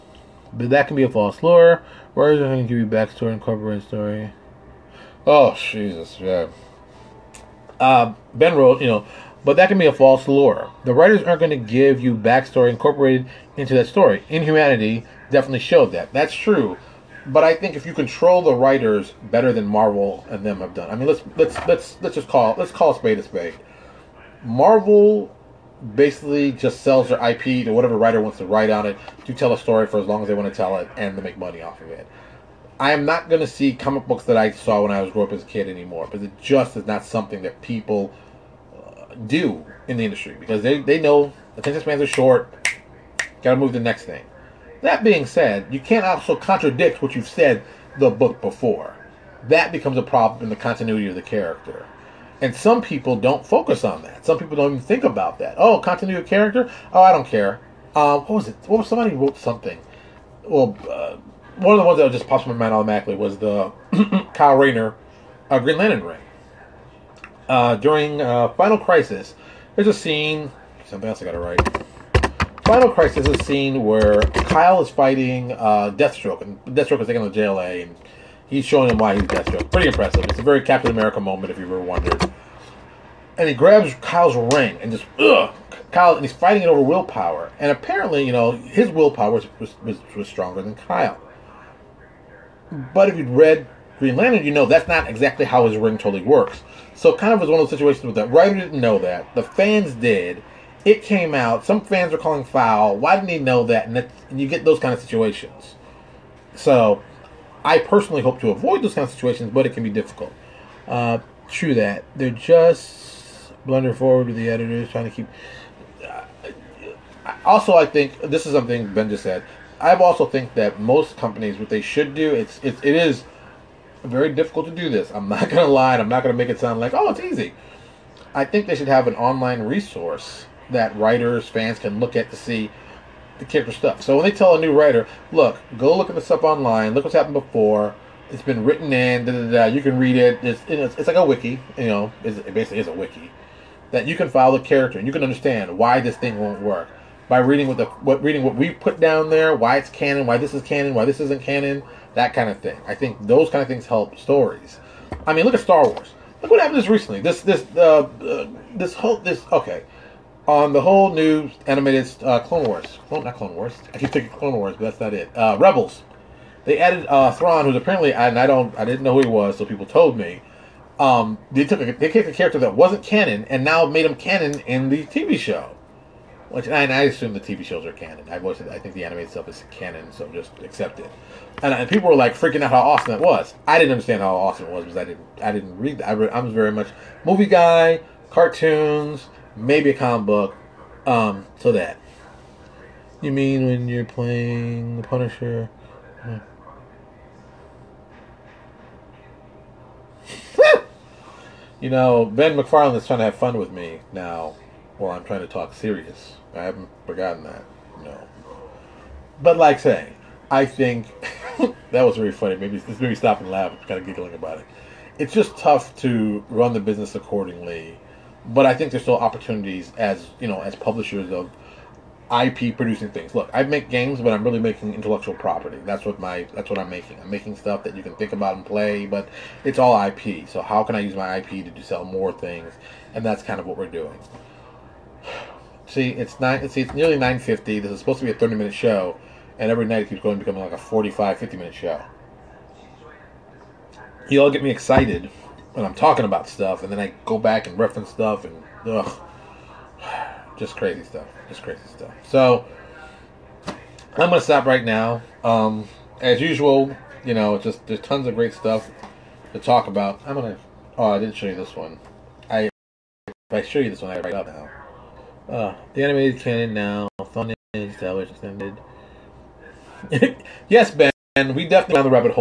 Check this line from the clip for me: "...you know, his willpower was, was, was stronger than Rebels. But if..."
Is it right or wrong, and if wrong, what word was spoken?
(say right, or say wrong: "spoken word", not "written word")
wrong: "Kyle", not "Rebels".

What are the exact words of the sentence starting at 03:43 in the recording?
Look, I make games, but I'm really making intellectual property.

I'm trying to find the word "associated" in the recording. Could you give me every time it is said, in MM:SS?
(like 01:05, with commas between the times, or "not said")
not said.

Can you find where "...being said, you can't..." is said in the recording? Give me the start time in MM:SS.
00:45.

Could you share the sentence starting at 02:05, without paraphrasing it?
I'm not gonna make it sound like oh, it's easy.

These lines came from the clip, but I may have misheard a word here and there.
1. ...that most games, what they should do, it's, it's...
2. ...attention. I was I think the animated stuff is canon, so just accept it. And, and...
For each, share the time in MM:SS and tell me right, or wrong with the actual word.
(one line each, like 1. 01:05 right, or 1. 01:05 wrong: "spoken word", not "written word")
1. 02:00 wrong: "companies", not "games"
2. 02:57 wrong: "canon", not "attention".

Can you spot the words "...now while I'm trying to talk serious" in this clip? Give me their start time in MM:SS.
03:24.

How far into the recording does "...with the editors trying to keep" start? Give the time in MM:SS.
01:54.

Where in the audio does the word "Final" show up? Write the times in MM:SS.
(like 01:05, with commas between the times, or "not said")
01:08, 01:12.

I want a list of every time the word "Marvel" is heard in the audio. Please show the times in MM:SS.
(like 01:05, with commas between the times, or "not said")
00:19, 00:24.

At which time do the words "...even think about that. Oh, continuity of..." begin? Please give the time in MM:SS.
00:54.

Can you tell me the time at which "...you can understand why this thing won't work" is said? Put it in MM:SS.
02:25.